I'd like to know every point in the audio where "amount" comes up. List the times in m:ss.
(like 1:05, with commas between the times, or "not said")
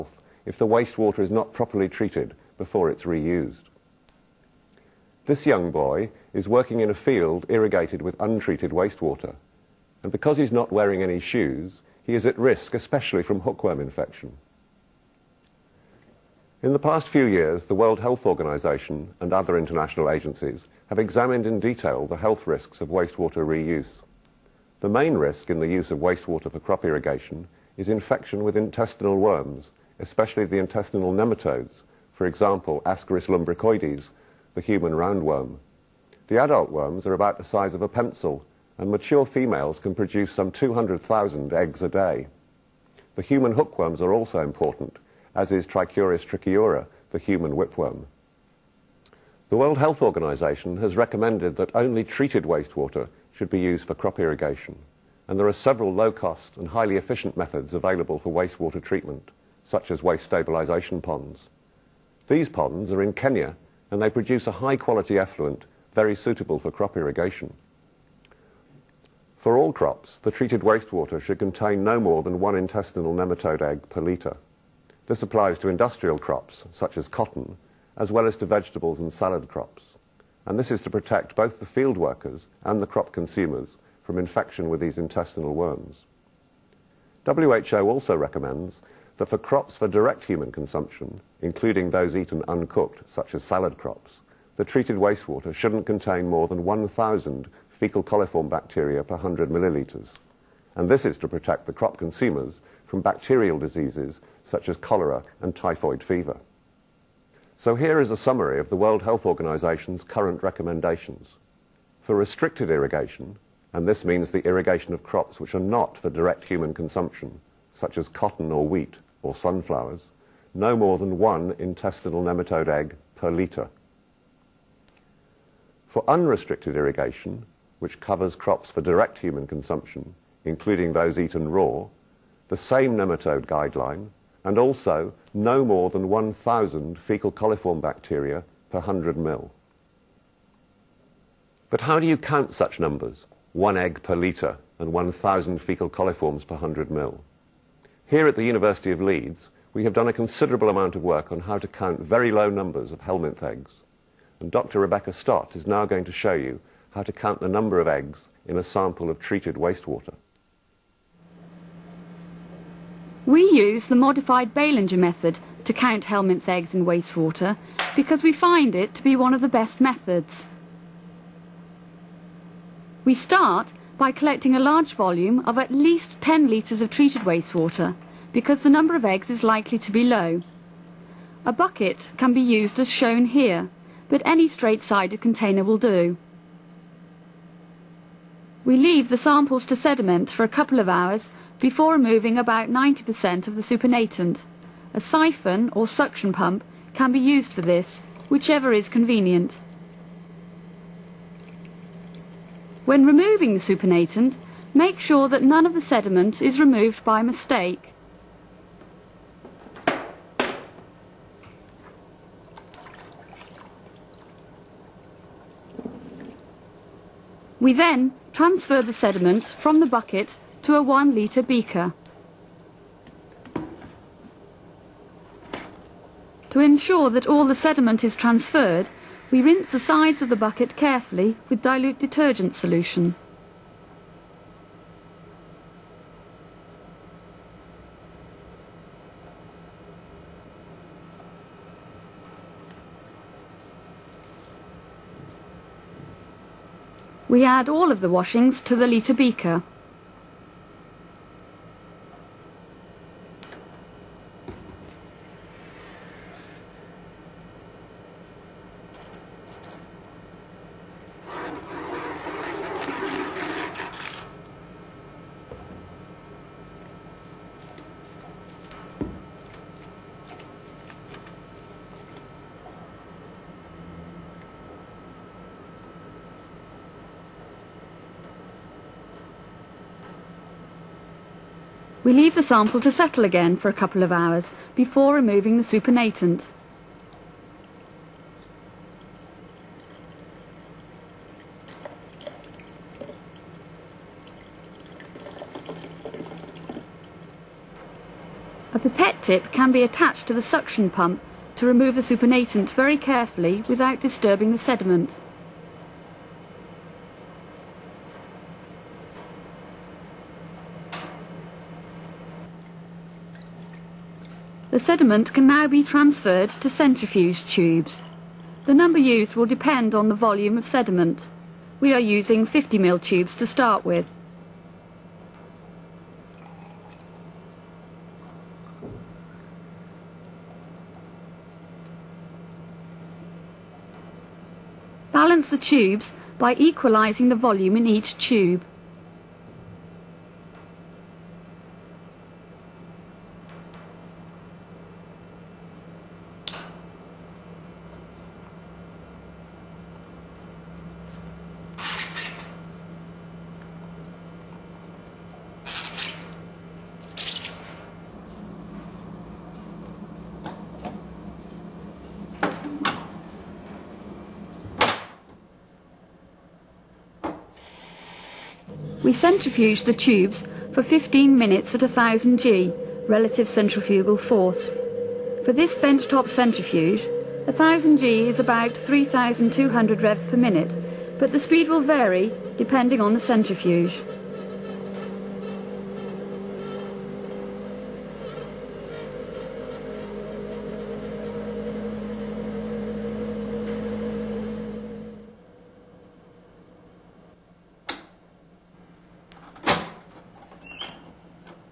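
2:30.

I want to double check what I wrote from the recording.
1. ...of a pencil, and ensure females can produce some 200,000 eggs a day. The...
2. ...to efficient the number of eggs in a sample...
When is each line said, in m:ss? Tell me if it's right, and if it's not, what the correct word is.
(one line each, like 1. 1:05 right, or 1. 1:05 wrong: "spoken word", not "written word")
1. 0:37 wrong: "mature", not "ensure"
2. 2:37 wrong: "count", not "efficient".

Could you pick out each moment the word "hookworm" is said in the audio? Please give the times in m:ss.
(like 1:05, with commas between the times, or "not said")
0:13, 0:43.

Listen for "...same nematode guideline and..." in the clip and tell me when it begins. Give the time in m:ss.
2:12.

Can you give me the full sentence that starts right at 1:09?
For all crops, the treated wastewater should contain no more than one intestinal nematode egg per litre.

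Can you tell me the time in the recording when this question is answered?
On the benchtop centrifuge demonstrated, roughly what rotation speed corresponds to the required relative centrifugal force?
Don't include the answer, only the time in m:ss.
6:18.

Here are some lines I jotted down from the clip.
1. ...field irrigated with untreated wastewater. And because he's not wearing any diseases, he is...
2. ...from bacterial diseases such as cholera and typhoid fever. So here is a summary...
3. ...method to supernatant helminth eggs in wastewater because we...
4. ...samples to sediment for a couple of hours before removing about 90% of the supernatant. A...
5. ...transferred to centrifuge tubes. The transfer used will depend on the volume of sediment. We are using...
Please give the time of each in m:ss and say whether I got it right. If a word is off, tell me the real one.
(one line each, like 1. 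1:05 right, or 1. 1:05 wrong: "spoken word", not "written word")
1. 0:06 wrong: "shoes", not "diseases"
2. 1:42 right
3. 2:44 wrong: "count", not "supernatant"
4. 3:09 right
5. 5:15 wrong: "number", not "transfer".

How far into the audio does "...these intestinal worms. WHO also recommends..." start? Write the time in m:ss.
1:24.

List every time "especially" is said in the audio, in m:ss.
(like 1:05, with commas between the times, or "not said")
0:12, 0:29.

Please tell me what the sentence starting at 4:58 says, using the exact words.
A pipette tip can be attached to the suction pump to remove the supernatant very carefully without disturbing the sediment.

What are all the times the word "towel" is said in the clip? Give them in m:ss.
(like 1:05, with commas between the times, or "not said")
not said.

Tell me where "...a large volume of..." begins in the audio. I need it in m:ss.
2:54.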